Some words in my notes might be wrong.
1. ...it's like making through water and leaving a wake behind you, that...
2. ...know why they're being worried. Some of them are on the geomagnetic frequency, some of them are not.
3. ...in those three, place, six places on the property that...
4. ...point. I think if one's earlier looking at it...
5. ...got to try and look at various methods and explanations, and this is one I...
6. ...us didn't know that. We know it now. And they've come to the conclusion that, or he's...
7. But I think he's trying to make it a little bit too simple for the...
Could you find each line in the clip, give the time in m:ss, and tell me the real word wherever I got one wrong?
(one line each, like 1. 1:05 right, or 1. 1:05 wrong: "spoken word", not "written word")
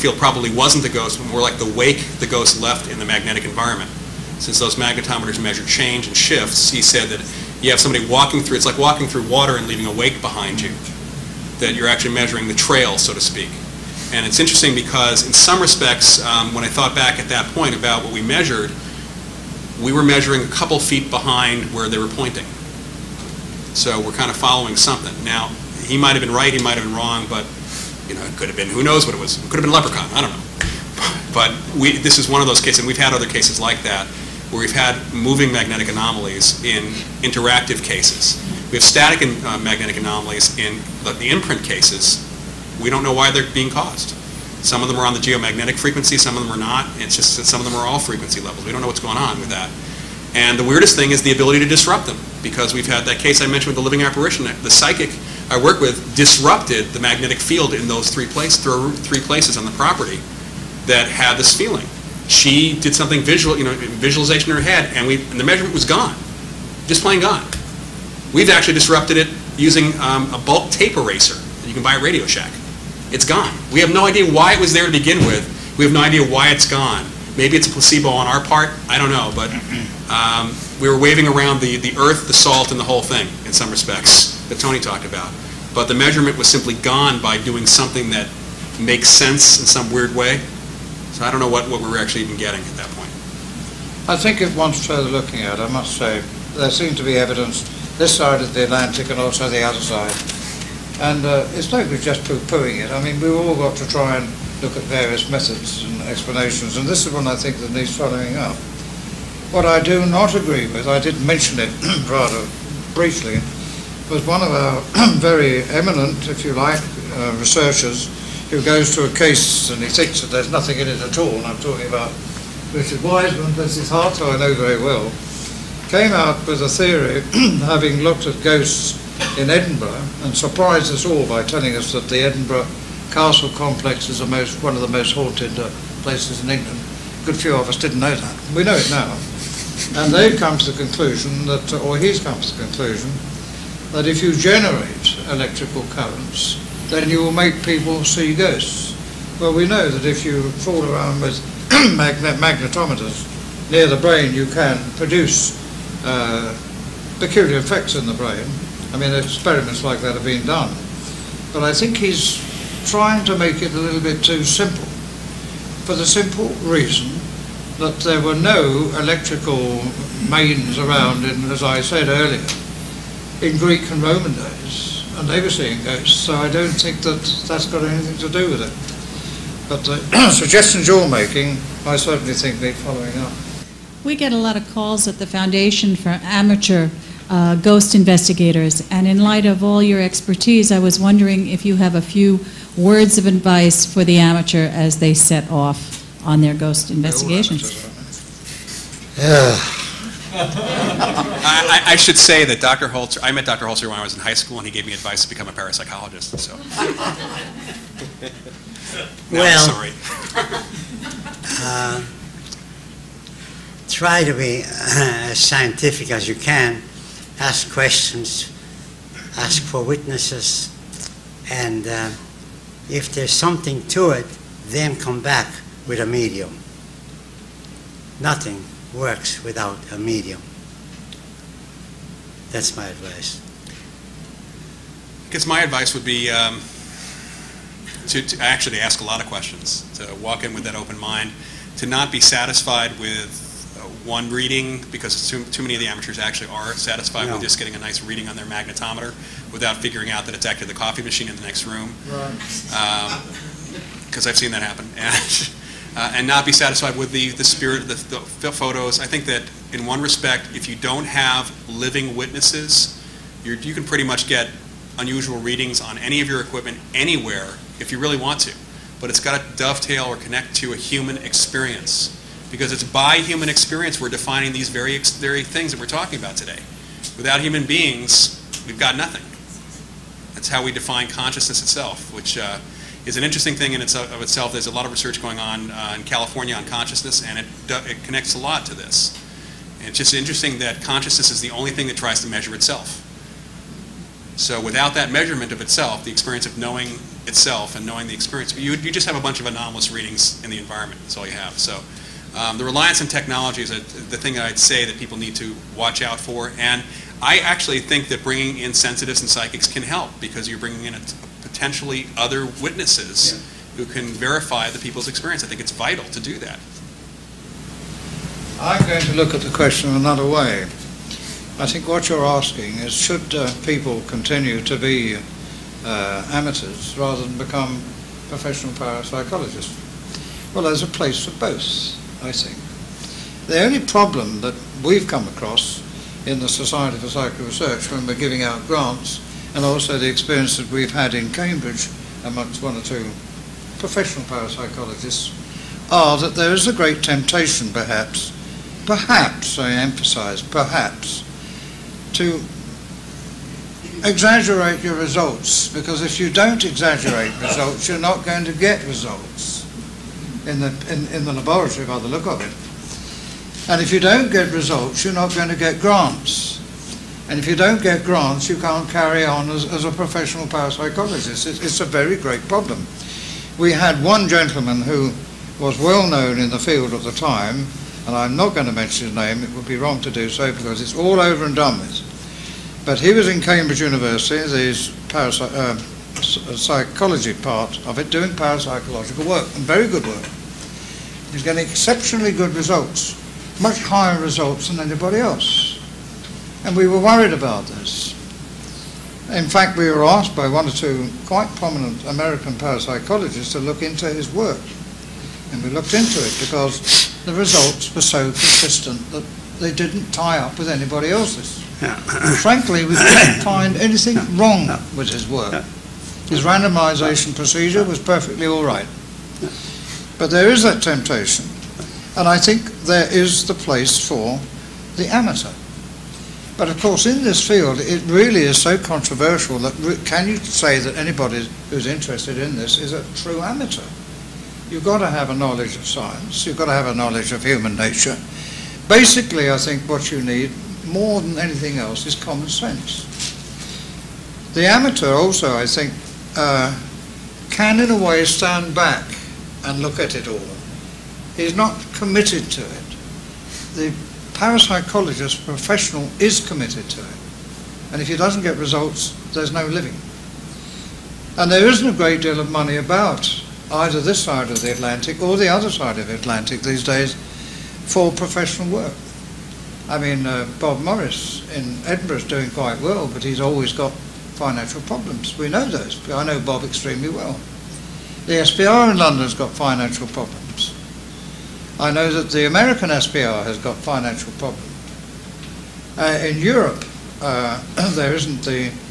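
1. 0:08 wrong: "walking", not "making"
2. 0:43 wrong: "caused", not "worried"
3. 0:57 wrong: "three", not "six"
4. 1:32 wrong: "further", not "earlier"
5. 1:43 right
6. 2:17 right
7. 2:41 right.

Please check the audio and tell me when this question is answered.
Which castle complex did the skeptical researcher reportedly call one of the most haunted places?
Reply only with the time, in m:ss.
2:12.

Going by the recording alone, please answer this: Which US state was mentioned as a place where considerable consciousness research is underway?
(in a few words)
California.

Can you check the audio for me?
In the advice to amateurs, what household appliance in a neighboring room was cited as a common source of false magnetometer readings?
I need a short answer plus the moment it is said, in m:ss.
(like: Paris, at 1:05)
coffee machine, at 4:10.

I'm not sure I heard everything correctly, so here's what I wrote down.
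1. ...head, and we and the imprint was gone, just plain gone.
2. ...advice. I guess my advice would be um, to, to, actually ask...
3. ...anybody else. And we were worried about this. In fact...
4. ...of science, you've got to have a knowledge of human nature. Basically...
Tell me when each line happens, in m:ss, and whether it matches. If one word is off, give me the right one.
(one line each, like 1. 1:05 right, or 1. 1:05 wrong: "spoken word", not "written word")
1. 1:04 wrong: "measurement", not "imprint"
2. 3:52 right
3. 6:34 right
4. 7:15 right.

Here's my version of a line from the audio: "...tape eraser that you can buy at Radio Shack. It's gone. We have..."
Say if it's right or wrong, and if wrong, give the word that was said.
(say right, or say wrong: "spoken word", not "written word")
right.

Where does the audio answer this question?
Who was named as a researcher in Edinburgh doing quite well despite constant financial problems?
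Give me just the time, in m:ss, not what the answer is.
7:50.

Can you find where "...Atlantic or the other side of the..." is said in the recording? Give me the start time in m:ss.
7:44.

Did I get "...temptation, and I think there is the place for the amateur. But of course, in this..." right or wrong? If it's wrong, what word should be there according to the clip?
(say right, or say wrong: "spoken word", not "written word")
right.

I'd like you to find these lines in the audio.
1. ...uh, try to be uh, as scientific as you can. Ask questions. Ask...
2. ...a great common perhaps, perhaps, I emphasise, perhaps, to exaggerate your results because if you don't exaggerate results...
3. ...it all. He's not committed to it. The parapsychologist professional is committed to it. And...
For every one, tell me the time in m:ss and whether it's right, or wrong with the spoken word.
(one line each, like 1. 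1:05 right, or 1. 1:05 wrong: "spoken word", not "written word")
1. 3:31 right
2. 5:46 wrong: "temptation", not "common"
3. 7:30 right.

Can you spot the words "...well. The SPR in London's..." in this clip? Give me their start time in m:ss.
7:57.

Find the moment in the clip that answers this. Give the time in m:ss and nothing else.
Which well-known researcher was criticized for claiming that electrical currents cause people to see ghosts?
2:02.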